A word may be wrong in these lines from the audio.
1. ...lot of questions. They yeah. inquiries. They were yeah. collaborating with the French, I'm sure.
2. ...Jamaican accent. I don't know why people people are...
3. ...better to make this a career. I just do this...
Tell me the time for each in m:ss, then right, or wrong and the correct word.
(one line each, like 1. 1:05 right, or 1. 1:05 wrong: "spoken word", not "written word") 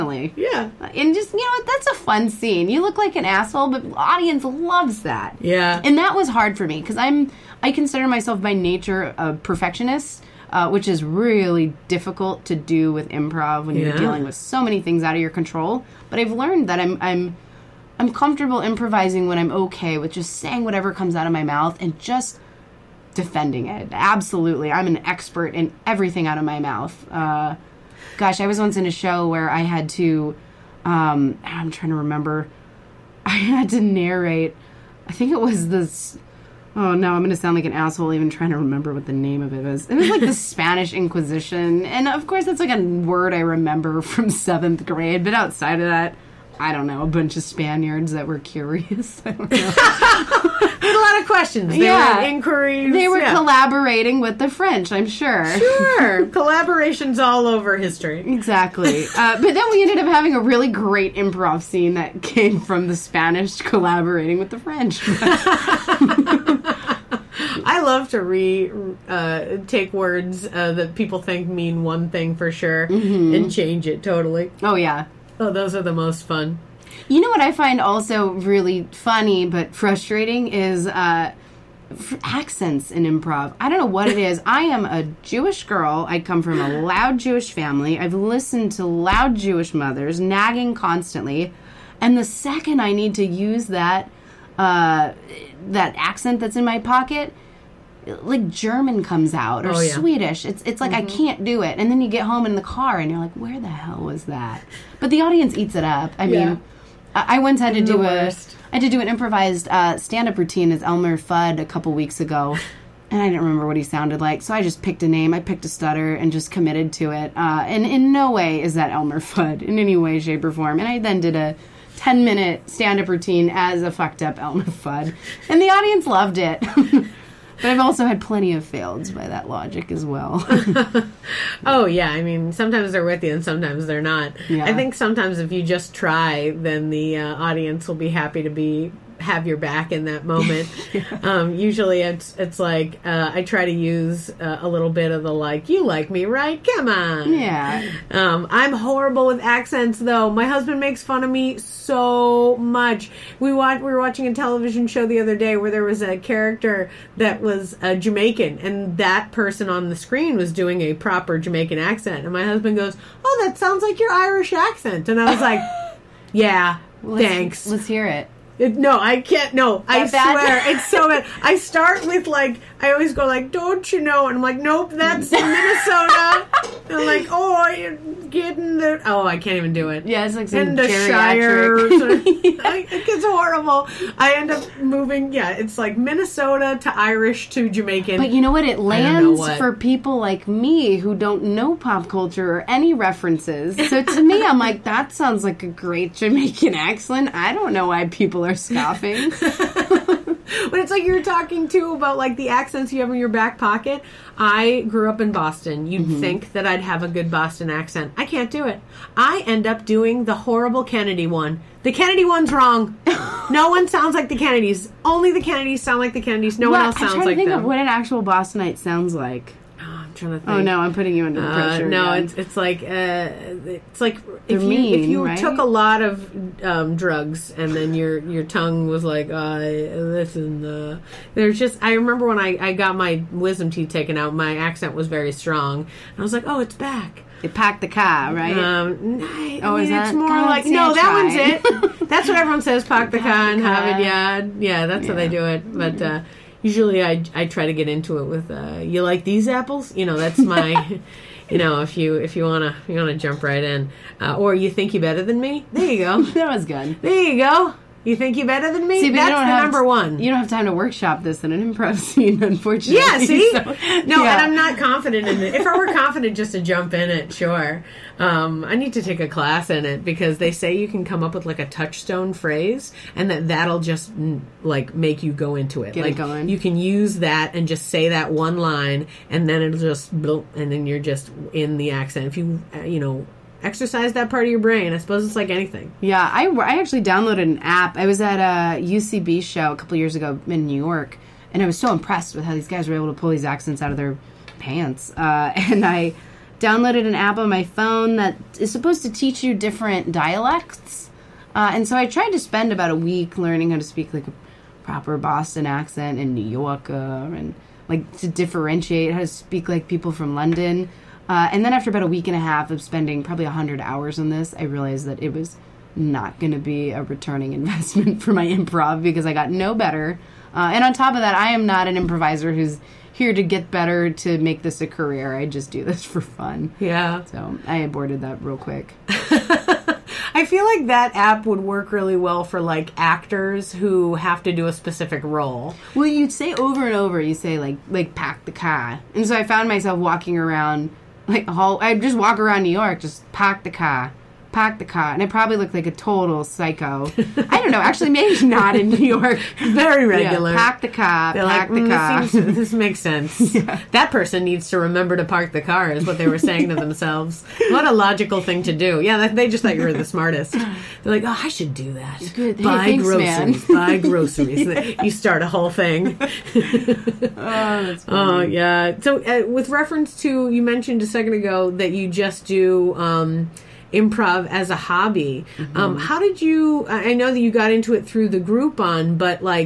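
1. 0:50 right
2. 3:16 right
3. 5:23 right.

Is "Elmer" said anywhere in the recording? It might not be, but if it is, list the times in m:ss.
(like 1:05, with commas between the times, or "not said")
1:50, 1:58, 2:04.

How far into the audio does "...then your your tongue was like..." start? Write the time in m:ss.
3:47.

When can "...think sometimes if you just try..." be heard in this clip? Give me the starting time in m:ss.
2:14.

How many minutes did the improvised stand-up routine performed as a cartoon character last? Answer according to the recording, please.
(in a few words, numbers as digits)
10.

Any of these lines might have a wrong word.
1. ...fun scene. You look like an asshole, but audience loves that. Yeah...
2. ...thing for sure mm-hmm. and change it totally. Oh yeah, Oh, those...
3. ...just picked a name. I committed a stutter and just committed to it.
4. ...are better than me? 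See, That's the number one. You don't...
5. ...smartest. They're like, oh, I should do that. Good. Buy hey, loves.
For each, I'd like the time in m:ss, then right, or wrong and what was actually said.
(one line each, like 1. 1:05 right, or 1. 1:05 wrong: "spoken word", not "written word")
1. 0:01 right
2. 1:12 right
3. 1:54 wrong: "picked", not "committed"
4. 4:18 right
5. 6:00 wrong: "groceries", not "loves".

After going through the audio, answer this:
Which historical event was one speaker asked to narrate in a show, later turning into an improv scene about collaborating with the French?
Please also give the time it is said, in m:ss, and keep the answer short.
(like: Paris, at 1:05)
Spanish Inquisition, at 0:40.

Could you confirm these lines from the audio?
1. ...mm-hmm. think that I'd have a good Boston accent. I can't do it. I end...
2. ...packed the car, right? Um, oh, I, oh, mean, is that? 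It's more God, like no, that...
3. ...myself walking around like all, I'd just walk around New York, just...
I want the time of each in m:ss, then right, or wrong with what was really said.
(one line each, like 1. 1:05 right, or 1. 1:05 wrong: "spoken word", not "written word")
1. 3:26 right
2. 3:57 right
3. 5:39 right.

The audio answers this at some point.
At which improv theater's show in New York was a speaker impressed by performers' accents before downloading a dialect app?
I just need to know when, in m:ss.
4:48.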